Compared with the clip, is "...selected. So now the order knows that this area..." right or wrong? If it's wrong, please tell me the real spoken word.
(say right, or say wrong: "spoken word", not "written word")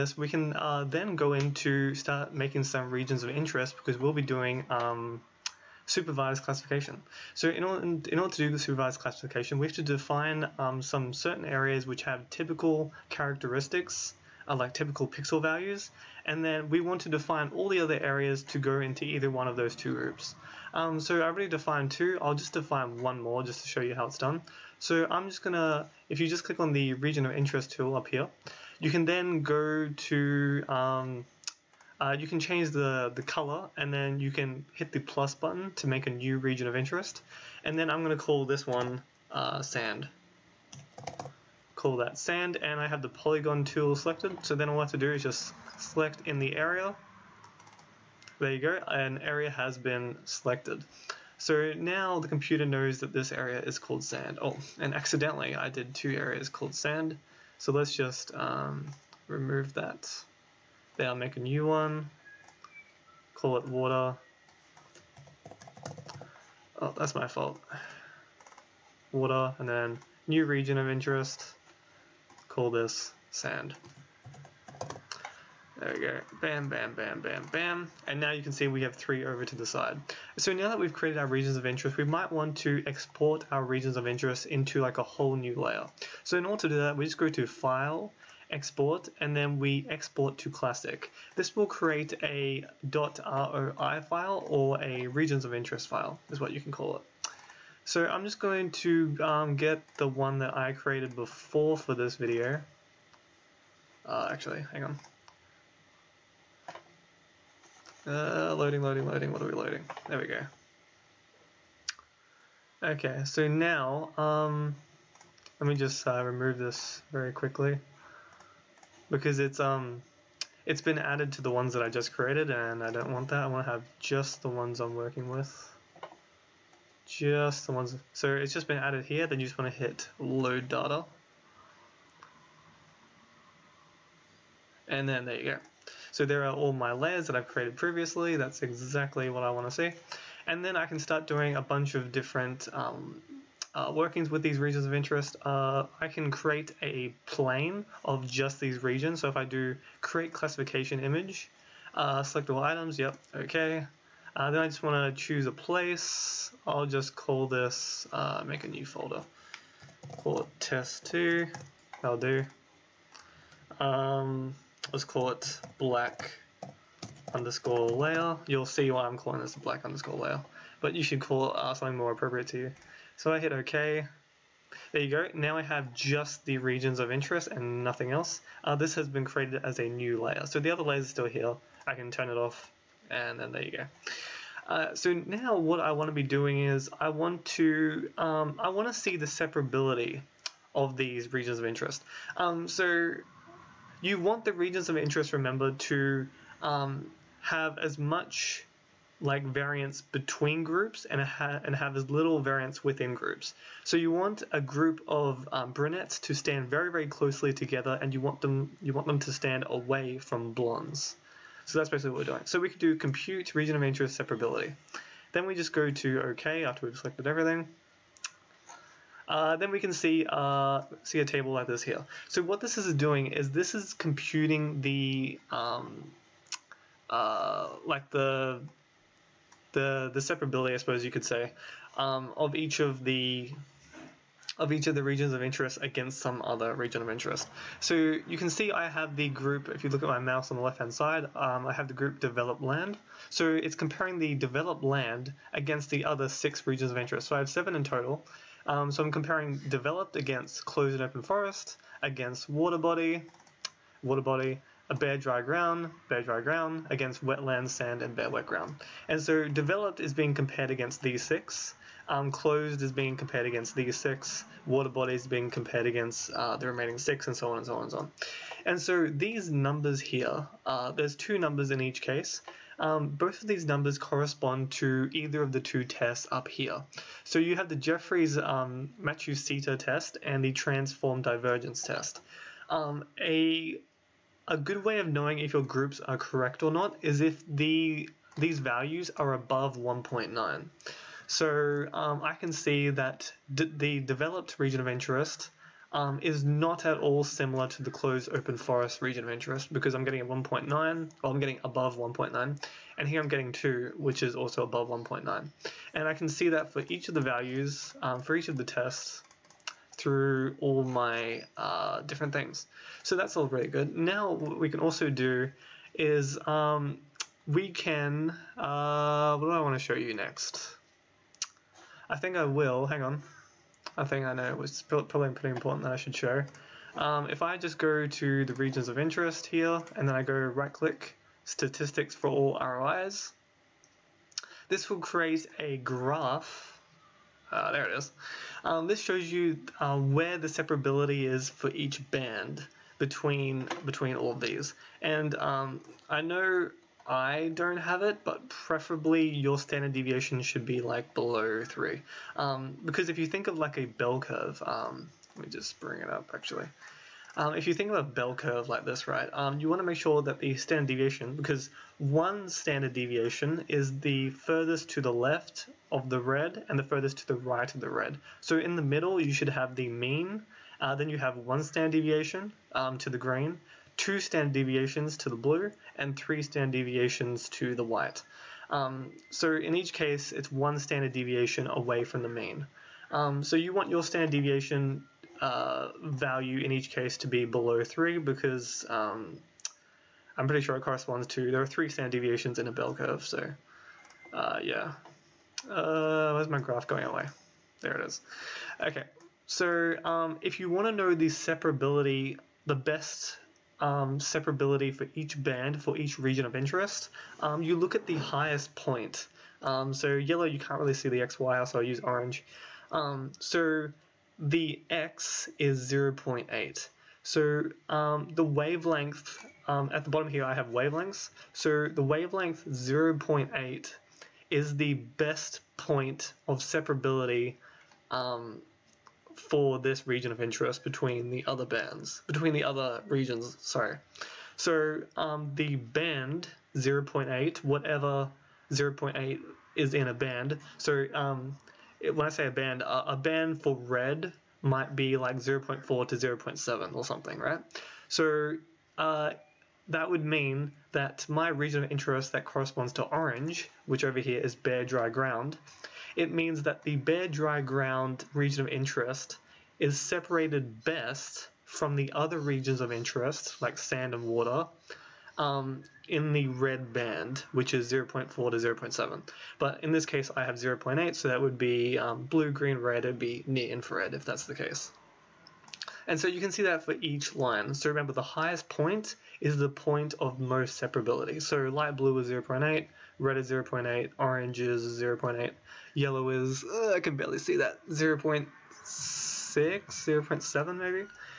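wrong: "computer", not "order".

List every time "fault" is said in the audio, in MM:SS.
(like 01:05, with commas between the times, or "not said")
01:07.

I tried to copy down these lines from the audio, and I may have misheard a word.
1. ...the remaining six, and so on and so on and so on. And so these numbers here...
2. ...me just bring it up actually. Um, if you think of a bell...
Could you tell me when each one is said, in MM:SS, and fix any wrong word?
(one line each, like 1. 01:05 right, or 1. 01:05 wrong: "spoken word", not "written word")
1. 04:26 right
2. 05:55 right.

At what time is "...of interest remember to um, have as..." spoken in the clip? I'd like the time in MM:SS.
03:14.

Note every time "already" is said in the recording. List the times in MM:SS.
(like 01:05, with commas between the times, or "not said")
00:21.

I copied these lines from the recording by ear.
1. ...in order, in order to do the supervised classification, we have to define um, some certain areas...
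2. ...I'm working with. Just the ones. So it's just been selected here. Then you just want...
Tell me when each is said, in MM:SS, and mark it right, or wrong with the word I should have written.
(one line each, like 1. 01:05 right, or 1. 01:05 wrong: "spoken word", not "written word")
1. 00:07 right
2. 02:04 wrong: "added", not "selected".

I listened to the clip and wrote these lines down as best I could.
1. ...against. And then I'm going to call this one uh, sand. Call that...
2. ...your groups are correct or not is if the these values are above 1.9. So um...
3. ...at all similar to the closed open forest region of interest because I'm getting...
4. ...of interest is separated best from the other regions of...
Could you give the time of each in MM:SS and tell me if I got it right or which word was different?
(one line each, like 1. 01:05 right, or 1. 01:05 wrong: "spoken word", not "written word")
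1. 00:36 wrong: "interest", not "against"
2. 04:45 right
3. 04:56 right
4. 07:38 right.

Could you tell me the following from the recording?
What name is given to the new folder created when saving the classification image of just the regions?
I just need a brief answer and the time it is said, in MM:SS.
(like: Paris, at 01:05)
test2, at 02:40.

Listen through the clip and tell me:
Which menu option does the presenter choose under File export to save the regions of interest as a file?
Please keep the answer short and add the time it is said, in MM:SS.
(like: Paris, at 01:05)
classic, at 01:29.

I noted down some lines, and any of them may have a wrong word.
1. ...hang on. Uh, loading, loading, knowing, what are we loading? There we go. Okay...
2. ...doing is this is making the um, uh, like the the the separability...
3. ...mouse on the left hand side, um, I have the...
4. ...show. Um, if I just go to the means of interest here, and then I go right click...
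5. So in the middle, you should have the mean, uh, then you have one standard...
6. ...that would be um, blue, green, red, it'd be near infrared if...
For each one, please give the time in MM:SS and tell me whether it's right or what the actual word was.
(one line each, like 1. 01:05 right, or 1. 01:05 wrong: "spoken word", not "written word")
1. 01:44 wrong: "loading", not "knowing"
2. 03:42 wrong: "computing", not "making"
3. 04:00 right
4. 05:26 wrong: "regions", not "means"
5. 06:08 right
6. 07:51 right.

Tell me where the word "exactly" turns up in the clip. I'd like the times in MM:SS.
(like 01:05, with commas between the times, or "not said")
02:18.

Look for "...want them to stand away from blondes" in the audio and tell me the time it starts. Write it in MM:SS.
03:28.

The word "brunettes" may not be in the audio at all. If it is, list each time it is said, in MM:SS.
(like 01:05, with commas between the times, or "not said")
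03:25.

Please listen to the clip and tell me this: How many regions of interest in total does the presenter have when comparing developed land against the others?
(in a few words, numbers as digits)
7.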